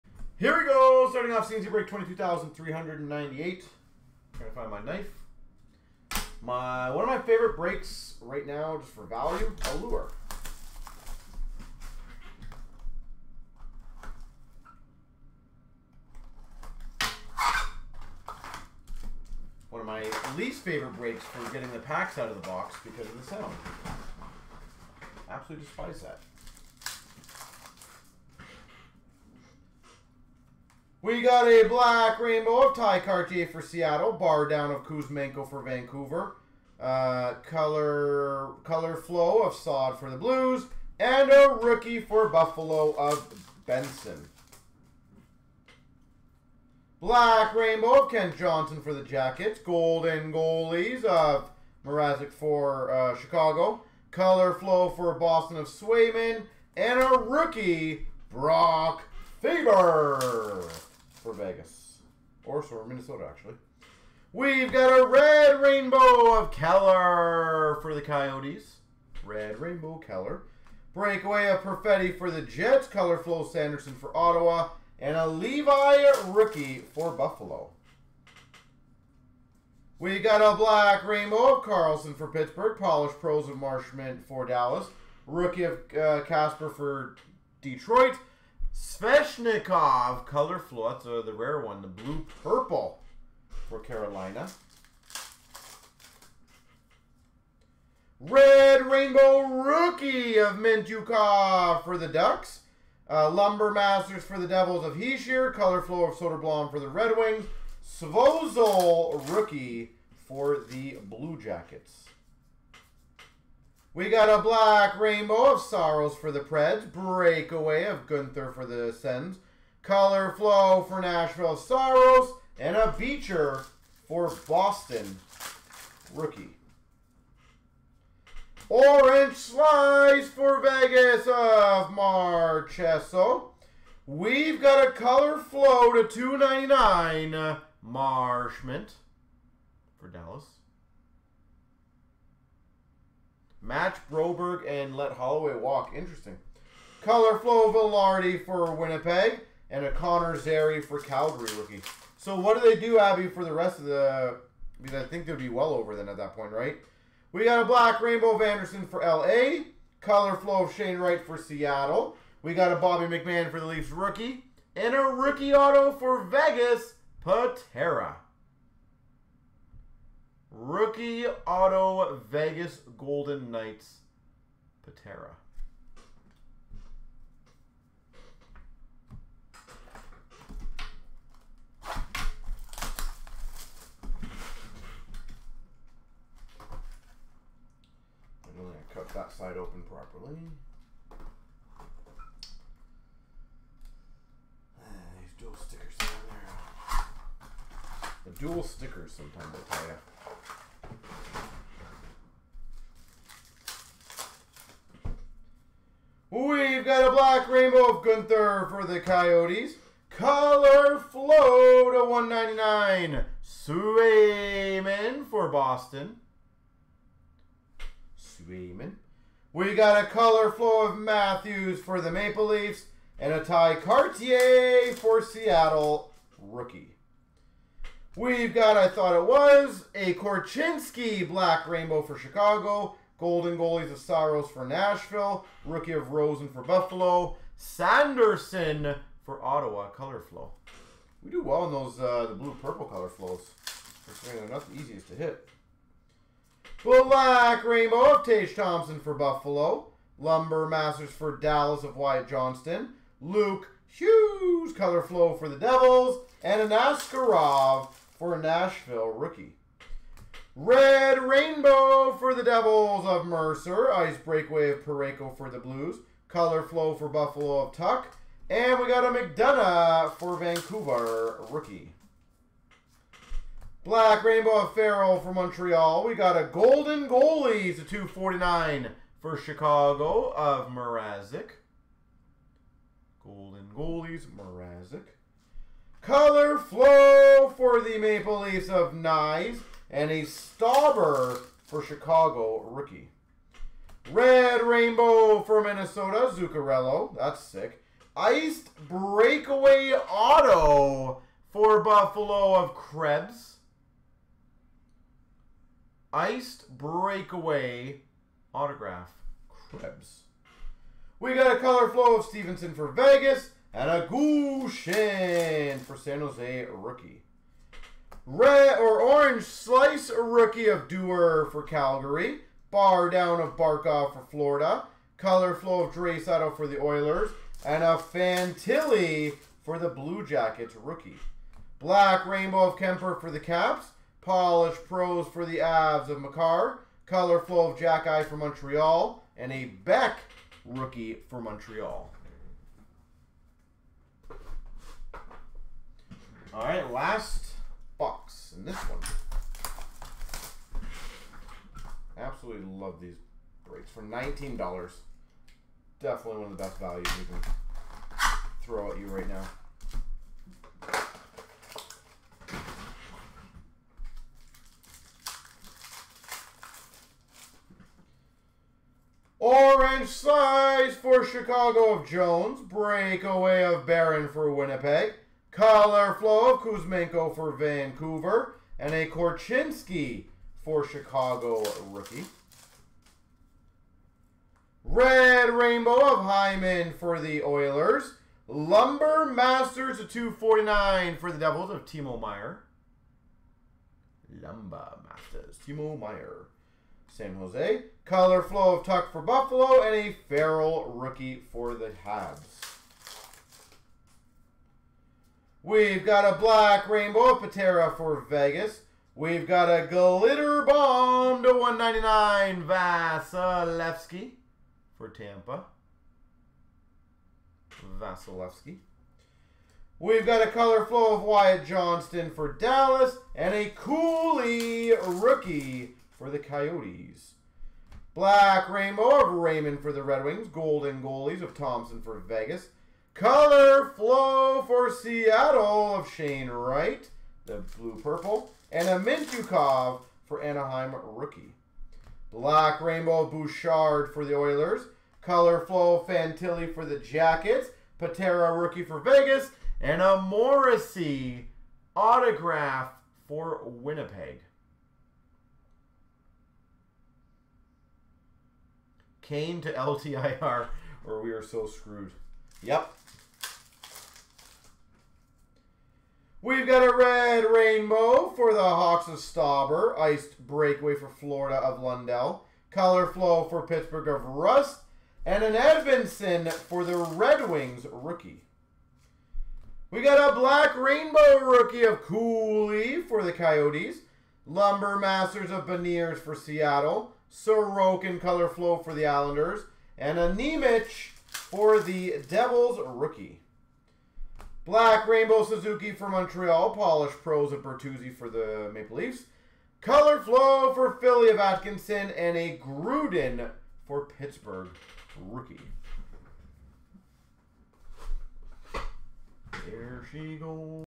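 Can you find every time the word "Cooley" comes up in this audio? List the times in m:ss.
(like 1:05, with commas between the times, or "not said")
7:03, 8:02.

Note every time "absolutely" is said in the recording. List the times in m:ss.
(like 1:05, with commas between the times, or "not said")
0:25, 5:52.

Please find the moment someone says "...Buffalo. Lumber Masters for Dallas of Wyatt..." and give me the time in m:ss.
4:09.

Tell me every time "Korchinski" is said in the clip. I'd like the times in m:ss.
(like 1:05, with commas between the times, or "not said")
3:50, 6:19.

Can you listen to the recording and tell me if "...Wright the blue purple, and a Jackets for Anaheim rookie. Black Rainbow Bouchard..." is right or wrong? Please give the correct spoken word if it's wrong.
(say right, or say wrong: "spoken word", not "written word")
wrong: "Mintyukov", not "Jackets".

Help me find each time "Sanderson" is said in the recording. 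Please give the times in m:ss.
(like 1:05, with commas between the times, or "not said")
1:13, 3:57.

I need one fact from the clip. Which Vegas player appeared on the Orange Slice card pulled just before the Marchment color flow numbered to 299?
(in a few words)
Marchessault.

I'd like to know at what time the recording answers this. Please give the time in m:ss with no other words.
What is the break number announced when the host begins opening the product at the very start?
0:01.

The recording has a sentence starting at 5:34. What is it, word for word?
Polished Pros for the Avs of Makar, Color flow of Jack Eye for Montreal.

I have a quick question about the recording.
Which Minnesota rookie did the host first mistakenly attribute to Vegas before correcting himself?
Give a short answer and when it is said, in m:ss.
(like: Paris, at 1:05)
Brock Faber, at 0:58.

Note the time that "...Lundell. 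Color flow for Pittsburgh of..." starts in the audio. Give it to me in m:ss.
7:51.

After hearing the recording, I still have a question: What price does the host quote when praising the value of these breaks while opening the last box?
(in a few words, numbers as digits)
$19.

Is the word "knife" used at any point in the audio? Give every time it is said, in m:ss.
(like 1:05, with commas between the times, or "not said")
0:04.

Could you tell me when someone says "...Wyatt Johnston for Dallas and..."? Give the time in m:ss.
7:01.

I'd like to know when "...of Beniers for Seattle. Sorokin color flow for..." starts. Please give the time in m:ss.
8:05.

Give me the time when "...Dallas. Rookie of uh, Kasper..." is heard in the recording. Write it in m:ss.
1:24.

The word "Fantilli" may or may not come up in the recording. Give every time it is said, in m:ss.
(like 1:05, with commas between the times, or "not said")
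5:27, 7:26.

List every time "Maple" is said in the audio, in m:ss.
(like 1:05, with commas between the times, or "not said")
3:42, 4:47, 8:18.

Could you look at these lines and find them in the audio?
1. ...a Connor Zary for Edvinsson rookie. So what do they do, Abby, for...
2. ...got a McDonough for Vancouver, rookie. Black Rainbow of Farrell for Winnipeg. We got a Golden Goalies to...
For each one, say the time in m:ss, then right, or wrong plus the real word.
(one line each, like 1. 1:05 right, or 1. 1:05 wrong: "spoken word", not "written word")
1. 2:29 wrong: "Calgary", not "Edvinsson"
2. 4:28 wrong: "Montreal", not "Winnipeg".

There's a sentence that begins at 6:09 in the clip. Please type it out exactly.
Orange size for Chicago of Jones.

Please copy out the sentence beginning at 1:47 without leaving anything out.
Svozil Rookie for the Blue Jackets.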